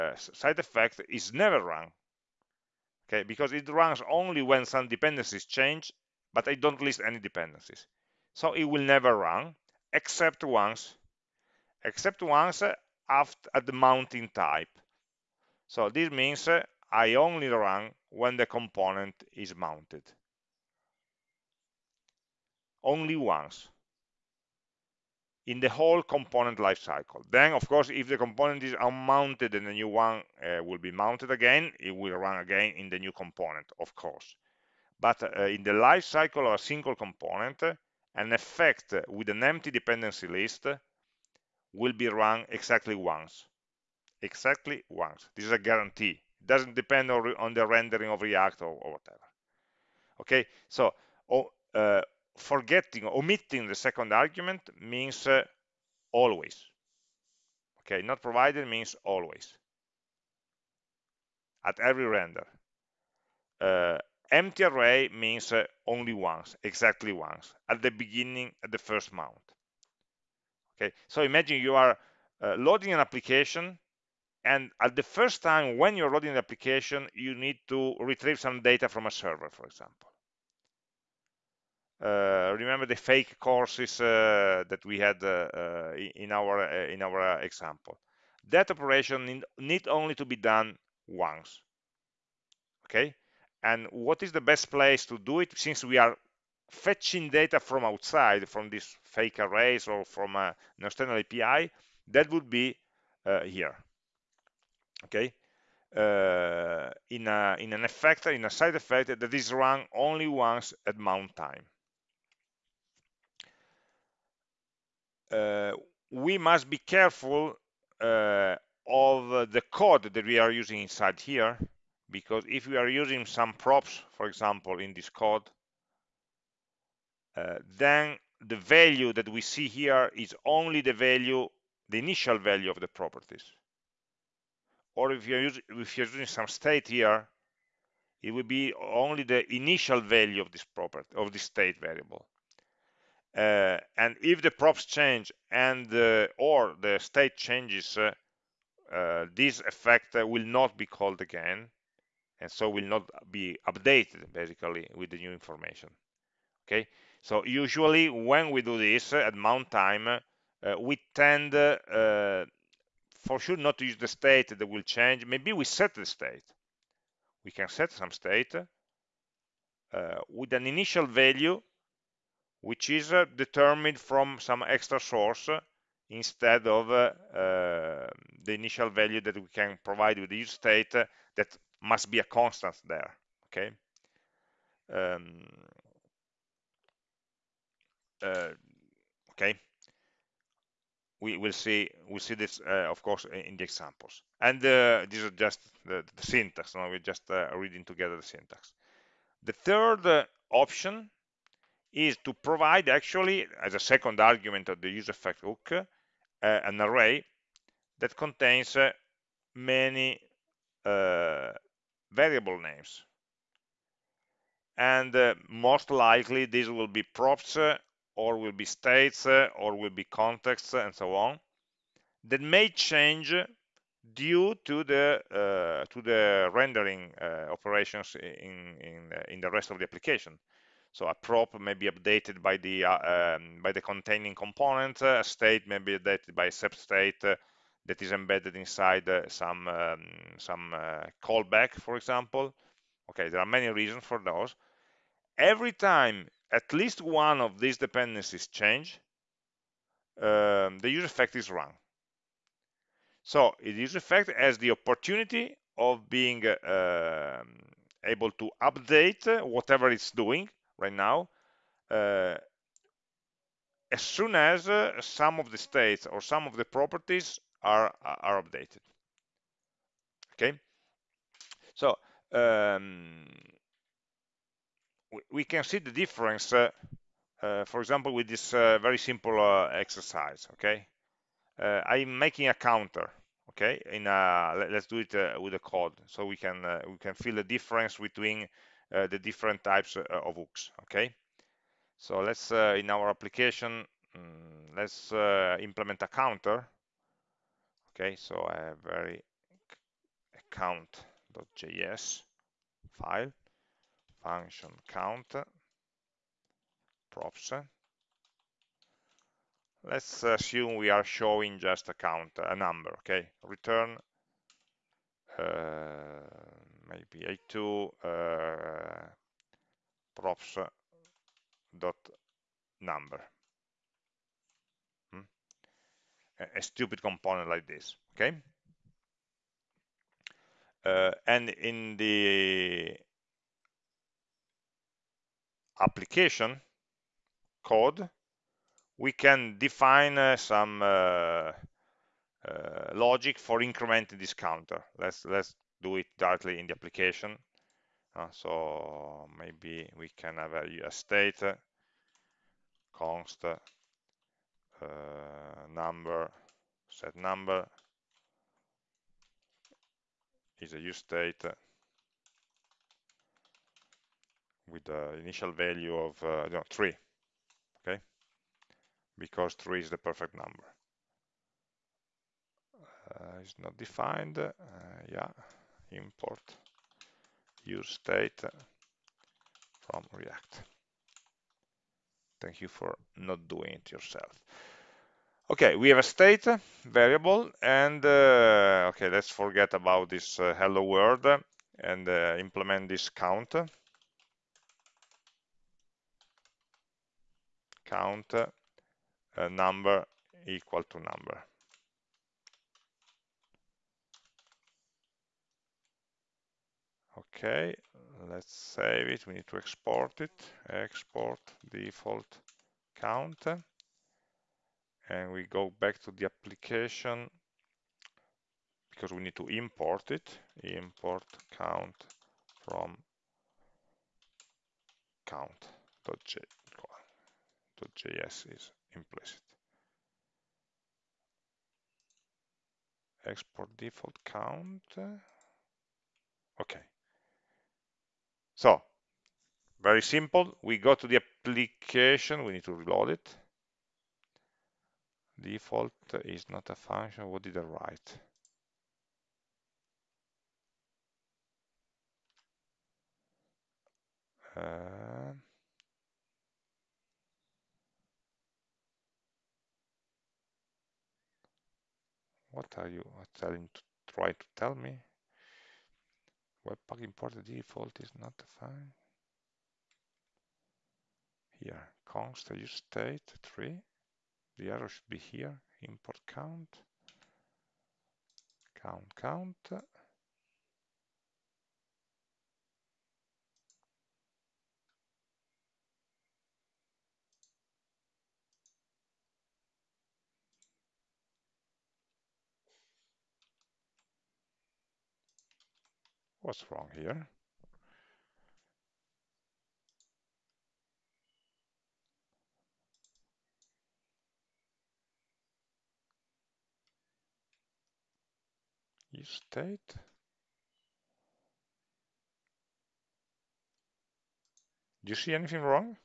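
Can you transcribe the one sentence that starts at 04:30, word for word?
Okay, so um, we can see the difference, uh, uh for example, with this uh, very simple uh, exercise.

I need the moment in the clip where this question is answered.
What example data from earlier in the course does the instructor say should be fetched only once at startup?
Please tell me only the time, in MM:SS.
01:22.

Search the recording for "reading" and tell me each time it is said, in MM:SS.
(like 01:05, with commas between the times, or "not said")
03:17.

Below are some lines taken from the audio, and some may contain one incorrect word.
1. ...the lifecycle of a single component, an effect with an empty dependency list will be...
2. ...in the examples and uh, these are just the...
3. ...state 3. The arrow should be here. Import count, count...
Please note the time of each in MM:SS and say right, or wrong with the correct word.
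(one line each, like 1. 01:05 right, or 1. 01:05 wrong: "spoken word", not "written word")
1. 00:35 right
2. 03:13 right
3. 07:52 right.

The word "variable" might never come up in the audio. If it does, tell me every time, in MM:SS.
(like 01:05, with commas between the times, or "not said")
02:21, 03:32, 06:26.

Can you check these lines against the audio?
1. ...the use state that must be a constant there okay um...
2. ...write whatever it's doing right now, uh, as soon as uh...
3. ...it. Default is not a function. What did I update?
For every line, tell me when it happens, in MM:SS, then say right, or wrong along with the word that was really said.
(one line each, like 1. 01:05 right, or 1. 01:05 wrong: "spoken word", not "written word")
1. 03:00 right
2. 04:18 wrong: "update", not "write"
3. 07:23 wrong: "write", not "update".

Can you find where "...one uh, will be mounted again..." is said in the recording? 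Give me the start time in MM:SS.
00:29.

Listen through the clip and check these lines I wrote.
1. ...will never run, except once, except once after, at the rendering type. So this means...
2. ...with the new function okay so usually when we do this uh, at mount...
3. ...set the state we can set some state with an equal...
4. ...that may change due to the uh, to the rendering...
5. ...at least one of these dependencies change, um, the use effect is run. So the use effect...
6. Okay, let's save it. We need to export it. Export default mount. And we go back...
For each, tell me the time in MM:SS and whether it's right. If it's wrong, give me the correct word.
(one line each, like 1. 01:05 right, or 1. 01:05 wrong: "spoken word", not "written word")
1. 00:08 wrong: "mounting", not "rendering"
2. 02:34 wrong: "information", not "function"
3. 02:45 wrong: "initial", not "equal"
4. 03:42 right
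5. 04:06 right
6. 06:47 wrong: "count", not "mount".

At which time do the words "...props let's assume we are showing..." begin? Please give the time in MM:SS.
05:07.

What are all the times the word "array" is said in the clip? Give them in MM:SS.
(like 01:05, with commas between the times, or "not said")
01:04, 01:39, 03:26.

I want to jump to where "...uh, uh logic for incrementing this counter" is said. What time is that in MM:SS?
05:40.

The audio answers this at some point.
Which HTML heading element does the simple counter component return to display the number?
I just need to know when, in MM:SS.
05:17.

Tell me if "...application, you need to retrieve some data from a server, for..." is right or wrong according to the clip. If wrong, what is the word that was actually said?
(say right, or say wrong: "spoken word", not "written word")
right.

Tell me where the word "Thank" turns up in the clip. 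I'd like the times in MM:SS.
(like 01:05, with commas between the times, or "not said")
06:22.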